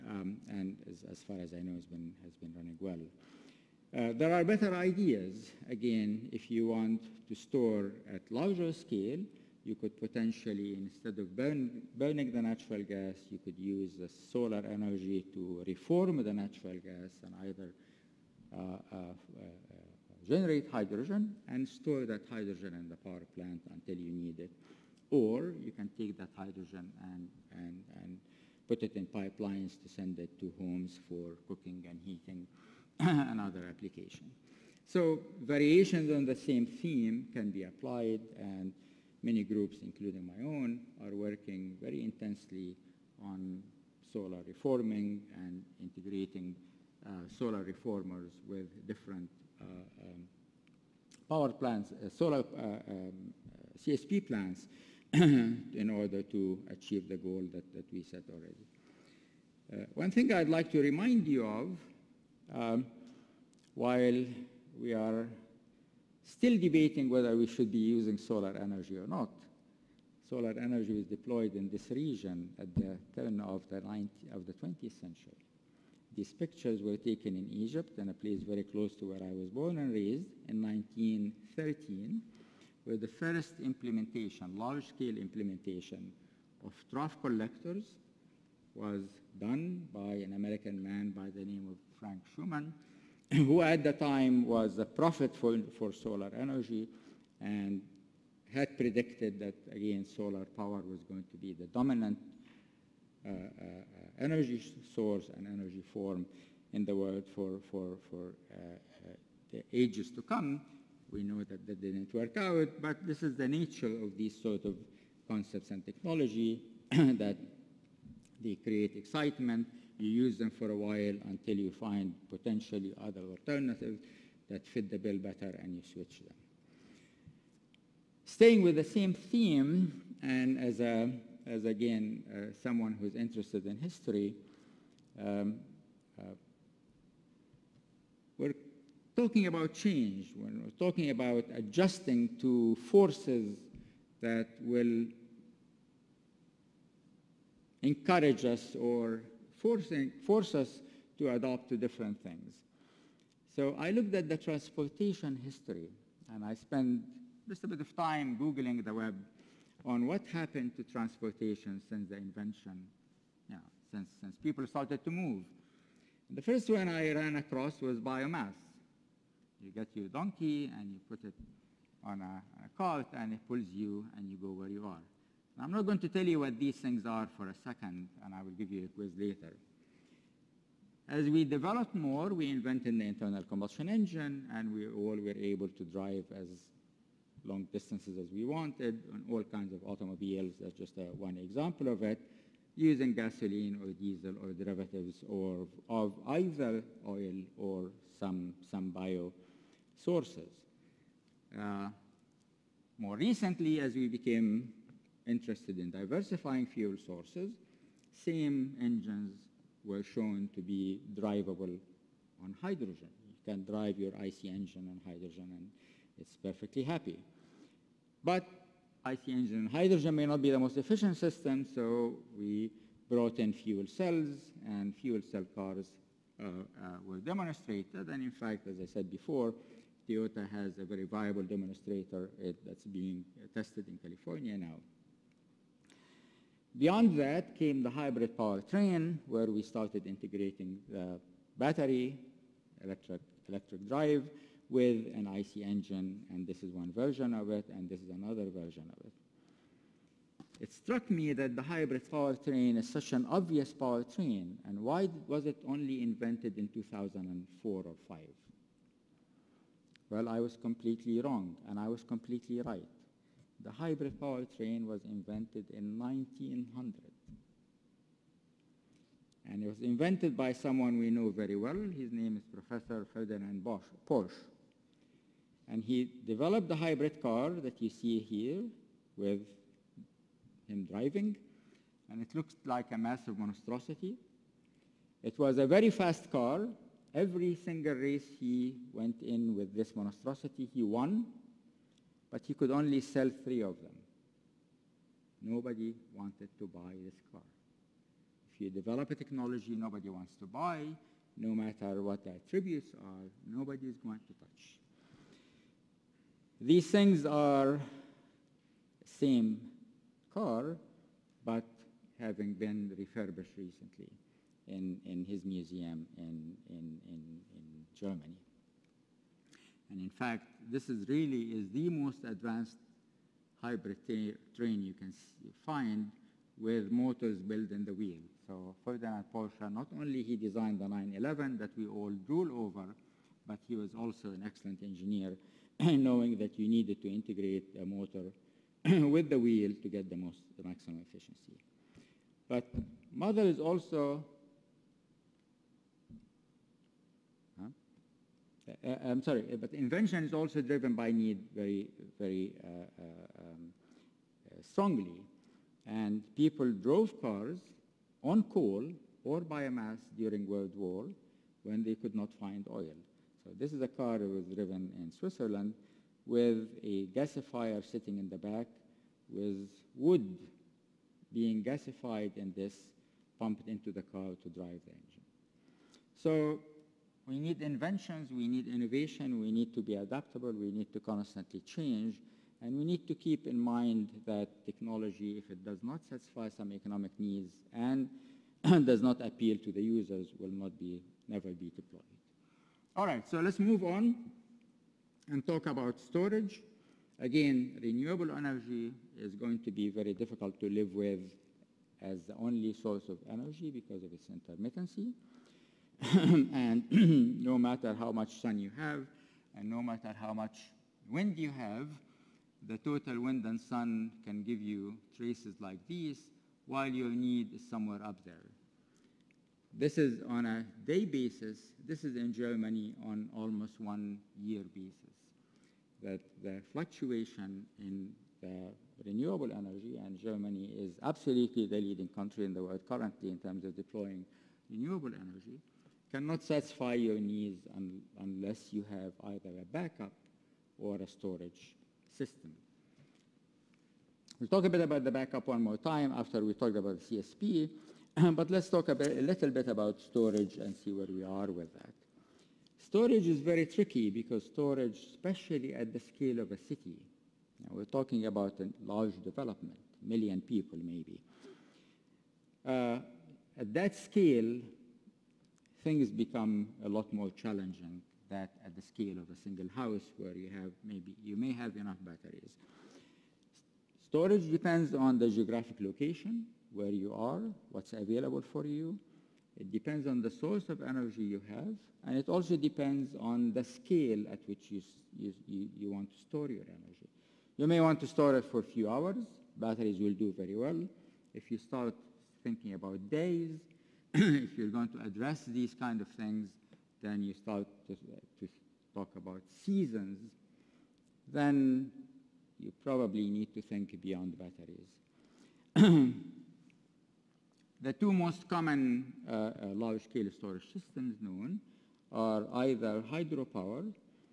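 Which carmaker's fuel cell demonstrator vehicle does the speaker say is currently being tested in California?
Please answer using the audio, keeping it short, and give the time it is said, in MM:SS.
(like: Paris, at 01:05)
Toyota, at 03:50.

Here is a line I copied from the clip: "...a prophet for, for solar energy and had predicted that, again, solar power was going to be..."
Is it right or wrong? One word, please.
right.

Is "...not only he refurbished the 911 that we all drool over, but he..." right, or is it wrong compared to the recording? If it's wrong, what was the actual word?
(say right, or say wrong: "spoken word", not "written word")
wrong: "designed", not "refurbished".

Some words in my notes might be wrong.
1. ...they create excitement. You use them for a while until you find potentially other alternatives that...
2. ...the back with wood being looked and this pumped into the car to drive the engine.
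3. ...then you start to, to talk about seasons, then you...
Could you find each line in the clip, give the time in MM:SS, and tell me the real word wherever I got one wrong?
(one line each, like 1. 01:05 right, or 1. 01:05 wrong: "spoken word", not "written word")
1. 01:58 right
2. 06:08 wrong: "gasified", not "looked"
3. 08:17 right.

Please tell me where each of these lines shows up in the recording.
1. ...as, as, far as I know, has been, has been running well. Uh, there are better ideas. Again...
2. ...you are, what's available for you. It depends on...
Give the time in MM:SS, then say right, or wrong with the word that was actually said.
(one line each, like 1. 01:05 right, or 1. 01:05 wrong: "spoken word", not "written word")
1. 00:00 right
2. 07:56 right.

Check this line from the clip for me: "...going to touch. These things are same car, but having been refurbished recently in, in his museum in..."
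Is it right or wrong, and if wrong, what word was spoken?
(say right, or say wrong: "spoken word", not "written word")
right.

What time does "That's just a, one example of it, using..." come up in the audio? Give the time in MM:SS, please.
03:10.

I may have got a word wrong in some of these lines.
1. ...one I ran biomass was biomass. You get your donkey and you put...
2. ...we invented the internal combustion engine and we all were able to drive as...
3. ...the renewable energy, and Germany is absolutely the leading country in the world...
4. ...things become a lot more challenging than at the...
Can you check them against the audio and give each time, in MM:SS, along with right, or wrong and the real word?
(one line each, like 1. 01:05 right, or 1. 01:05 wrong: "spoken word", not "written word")
1. 02:46 wrong: "across", not "biomass"
2. 03:02 right
3. 07:08 right
4. 07:45 right.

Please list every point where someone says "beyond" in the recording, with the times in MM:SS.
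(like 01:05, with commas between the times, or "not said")
03:56, 08:24.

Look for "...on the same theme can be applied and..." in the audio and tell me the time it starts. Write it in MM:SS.
00:36.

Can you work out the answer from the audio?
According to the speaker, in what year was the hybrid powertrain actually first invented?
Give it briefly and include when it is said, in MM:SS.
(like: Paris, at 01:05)
1900, at 04:25.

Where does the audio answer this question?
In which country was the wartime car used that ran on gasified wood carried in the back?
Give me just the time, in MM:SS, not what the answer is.
06:05.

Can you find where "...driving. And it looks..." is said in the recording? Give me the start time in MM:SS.
04:40.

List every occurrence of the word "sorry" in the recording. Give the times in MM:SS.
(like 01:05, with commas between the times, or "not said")
05:49.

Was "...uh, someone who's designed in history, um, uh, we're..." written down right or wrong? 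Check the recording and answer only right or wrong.
wrong.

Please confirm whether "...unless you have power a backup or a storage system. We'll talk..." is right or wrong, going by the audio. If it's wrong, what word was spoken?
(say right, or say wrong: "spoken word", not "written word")
wrong: "either", not "power".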